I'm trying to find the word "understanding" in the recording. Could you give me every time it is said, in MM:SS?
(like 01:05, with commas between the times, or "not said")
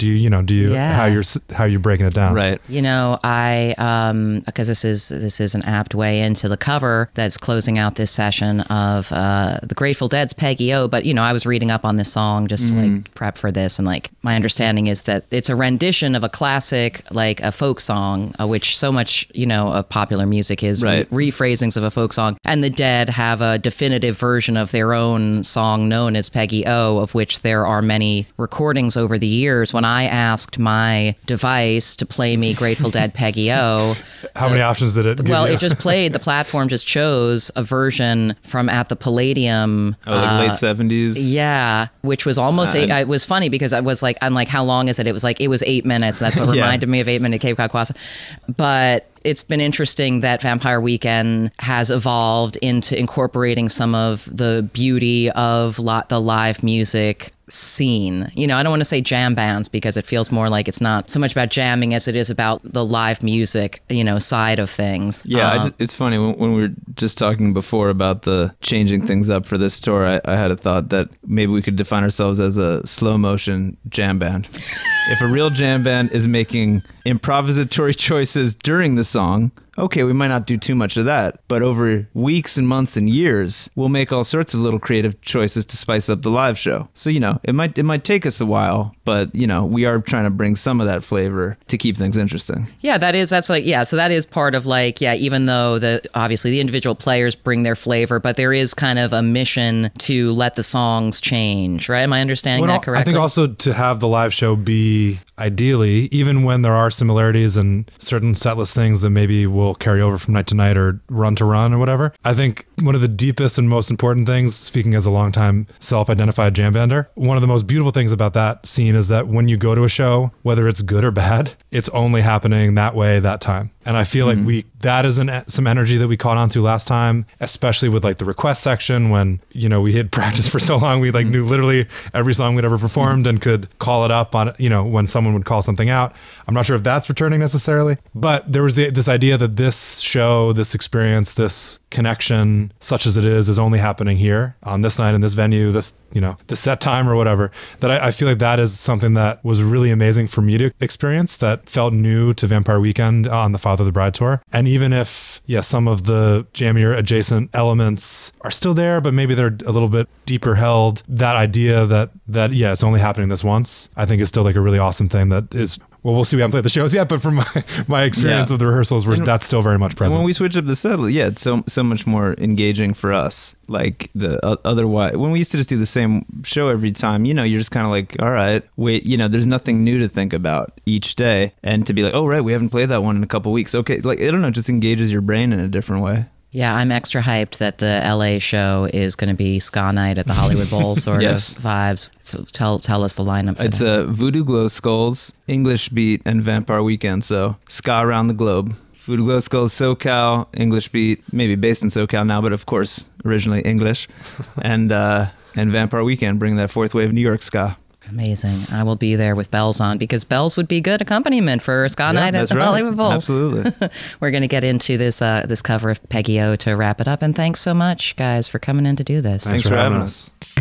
00:14, 01:42.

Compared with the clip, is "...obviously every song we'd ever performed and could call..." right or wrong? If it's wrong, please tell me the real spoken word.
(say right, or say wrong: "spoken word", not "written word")
wrong: "literally", not "obviously".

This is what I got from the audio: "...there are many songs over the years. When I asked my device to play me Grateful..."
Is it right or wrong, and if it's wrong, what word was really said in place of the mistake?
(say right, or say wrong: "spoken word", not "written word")
wrong: "recordings", not "songs".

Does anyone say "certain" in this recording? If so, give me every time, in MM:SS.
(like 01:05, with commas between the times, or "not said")
01:47.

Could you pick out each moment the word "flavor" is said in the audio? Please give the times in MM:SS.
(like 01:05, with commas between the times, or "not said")
01:31, 01:37.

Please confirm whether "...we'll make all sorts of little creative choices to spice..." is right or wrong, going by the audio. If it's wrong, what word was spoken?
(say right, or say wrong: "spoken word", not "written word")
right.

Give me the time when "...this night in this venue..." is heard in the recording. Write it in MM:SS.
02:24.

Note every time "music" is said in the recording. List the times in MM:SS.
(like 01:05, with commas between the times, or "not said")
00:20, 00:56, 01:03.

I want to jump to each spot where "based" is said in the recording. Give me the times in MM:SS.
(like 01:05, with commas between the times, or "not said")
03:21.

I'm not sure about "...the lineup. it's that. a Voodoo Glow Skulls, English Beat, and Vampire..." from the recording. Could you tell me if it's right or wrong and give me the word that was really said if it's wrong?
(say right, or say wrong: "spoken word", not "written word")
right.